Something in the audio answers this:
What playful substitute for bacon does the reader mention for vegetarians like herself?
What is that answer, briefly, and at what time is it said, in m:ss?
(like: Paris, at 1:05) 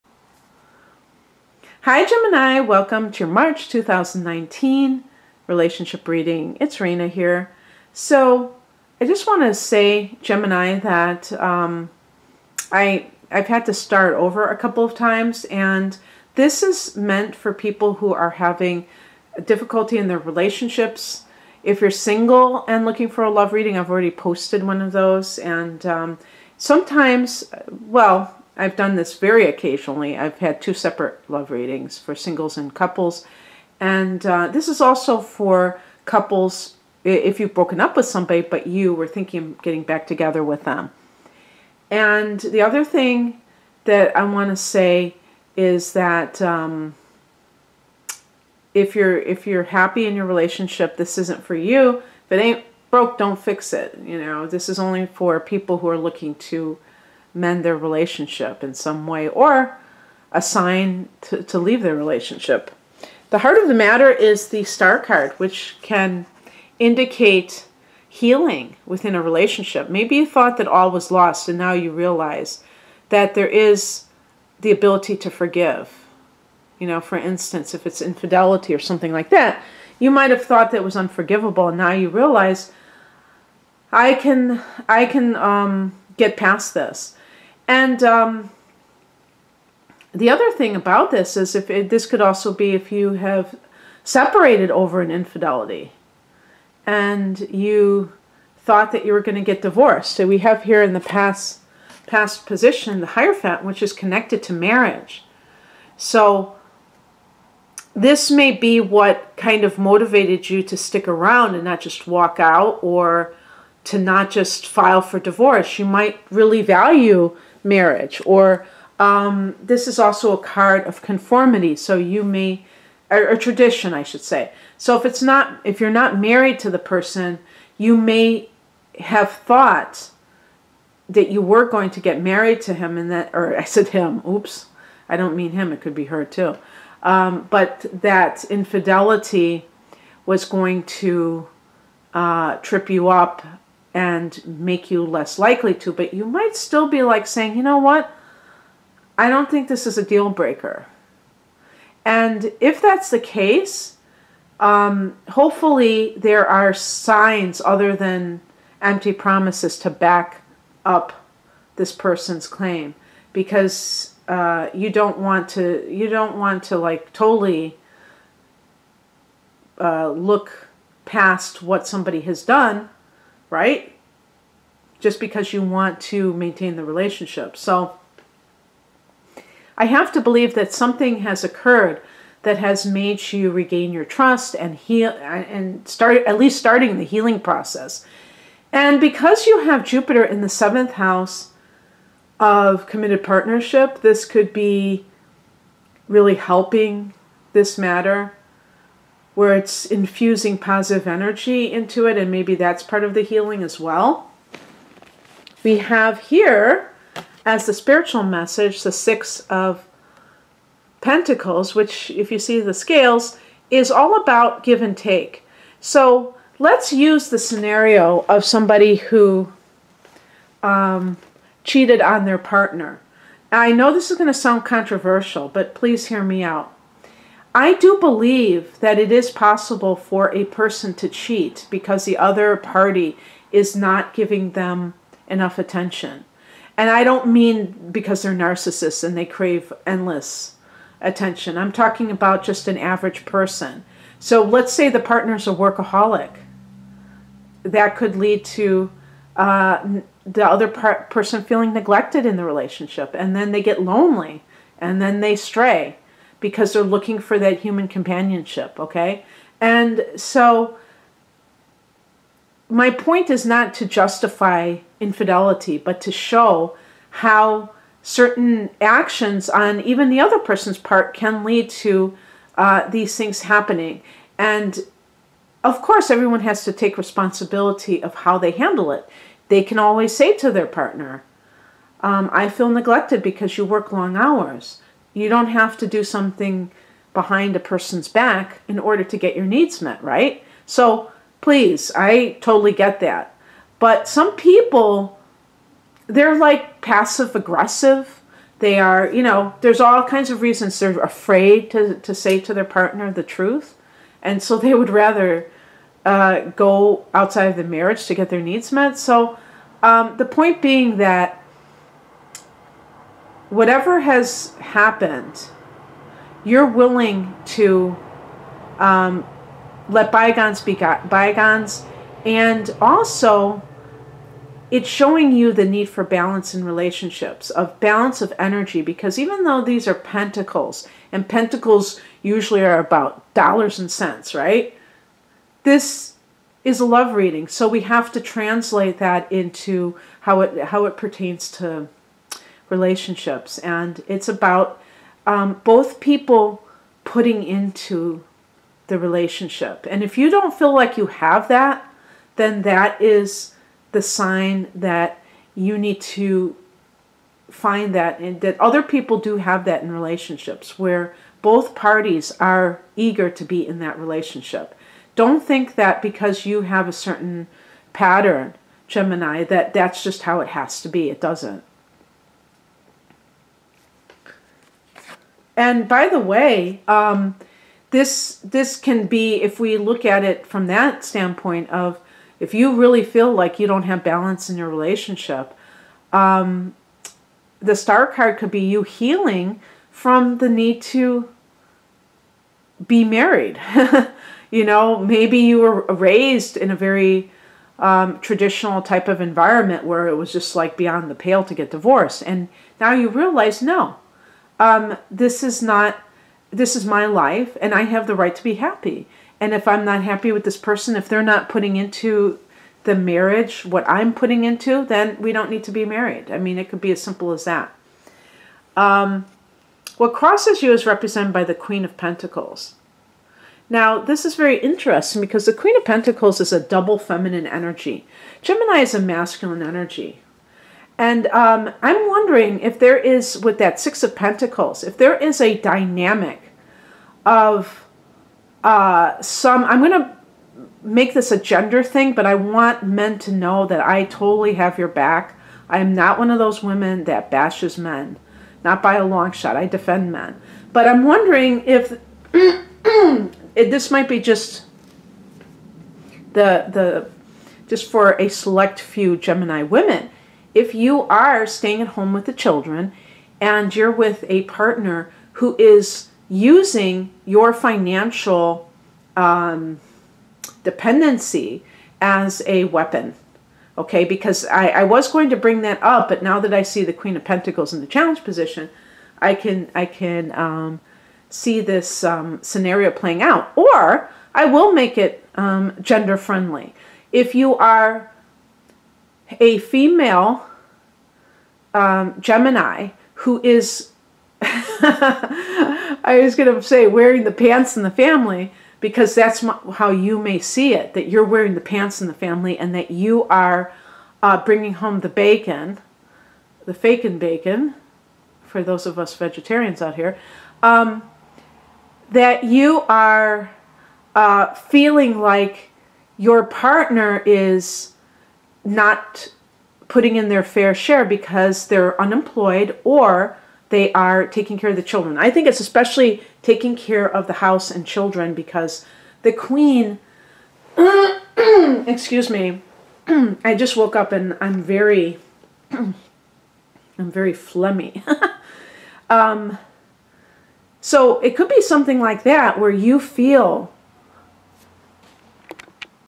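Fake and bacon, at 8:26.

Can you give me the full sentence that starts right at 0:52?
If it ain't broke, don't fix it.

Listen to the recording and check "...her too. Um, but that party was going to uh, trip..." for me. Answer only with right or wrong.
wrong.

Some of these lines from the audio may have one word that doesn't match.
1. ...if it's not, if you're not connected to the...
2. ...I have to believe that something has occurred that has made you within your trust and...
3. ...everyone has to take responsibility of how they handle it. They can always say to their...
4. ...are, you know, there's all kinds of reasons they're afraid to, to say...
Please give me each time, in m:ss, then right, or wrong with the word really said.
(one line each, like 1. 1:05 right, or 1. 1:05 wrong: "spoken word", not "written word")
1. 2:04 wrong: "married", not "connected"
2. 2:59 wrong: "regain", not "within"
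3. 4:36 right
4. 4:58 right.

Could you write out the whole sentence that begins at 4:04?
So let's say the partner's a workaholic.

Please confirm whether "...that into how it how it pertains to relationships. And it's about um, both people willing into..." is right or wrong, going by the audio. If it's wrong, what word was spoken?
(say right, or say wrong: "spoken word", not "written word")
wrong: "putting", not "willing".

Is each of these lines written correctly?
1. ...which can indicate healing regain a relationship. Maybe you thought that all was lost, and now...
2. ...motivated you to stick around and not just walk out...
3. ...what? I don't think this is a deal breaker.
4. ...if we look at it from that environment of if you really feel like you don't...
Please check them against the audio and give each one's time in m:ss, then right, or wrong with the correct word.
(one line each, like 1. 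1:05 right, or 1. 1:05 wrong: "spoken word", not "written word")
1. 1:05 wrong: "within", not "regain"
2. 1:49 right
3. 2:27 right
4. 6:19 wrong: "standpoint", not "environment".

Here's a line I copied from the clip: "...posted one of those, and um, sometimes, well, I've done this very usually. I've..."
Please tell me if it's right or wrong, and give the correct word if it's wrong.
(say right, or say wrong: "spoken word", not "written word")
wrong: "occasionally", not "usually".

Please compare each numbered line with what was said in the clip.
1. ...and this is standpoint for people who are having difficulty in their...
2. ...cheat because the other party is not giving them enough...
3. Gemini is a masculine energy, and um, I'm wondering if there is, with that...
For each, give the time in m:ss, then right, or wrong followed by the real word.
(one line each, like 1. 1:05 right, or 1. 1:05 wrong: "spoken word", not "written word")
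1. 0:15 wrong: "meant", not "standpoint"
2. 3:51 right
3. 7:08 right.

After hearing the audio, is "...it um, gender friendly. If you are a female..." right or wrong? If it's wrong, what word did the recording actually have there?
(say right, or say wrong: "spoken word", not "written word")
right.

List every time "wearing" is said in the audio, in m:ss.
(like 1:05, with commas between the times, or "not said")
8:16, 8:21.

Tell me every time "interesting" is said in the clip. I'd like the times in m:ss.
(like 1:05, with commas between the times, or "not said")
7:04.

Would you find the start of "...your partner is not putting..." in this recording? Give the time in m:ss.
8:36.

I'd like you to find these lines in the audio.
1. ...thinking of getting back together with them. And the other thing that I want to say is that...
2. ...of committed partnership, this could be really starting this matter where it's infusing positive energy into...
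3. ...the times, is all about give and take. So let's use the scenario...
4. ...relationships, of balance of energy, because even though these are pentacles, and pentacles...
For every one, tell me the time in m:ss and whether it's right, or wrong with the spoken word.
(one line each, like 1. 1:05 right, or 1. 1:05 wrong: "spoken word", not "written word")
1. 0:39 right
2. 3:12 wrong: "helping", not "starting"
3. 3:32 wrong: "scales", not "times"
4. 5:26 right.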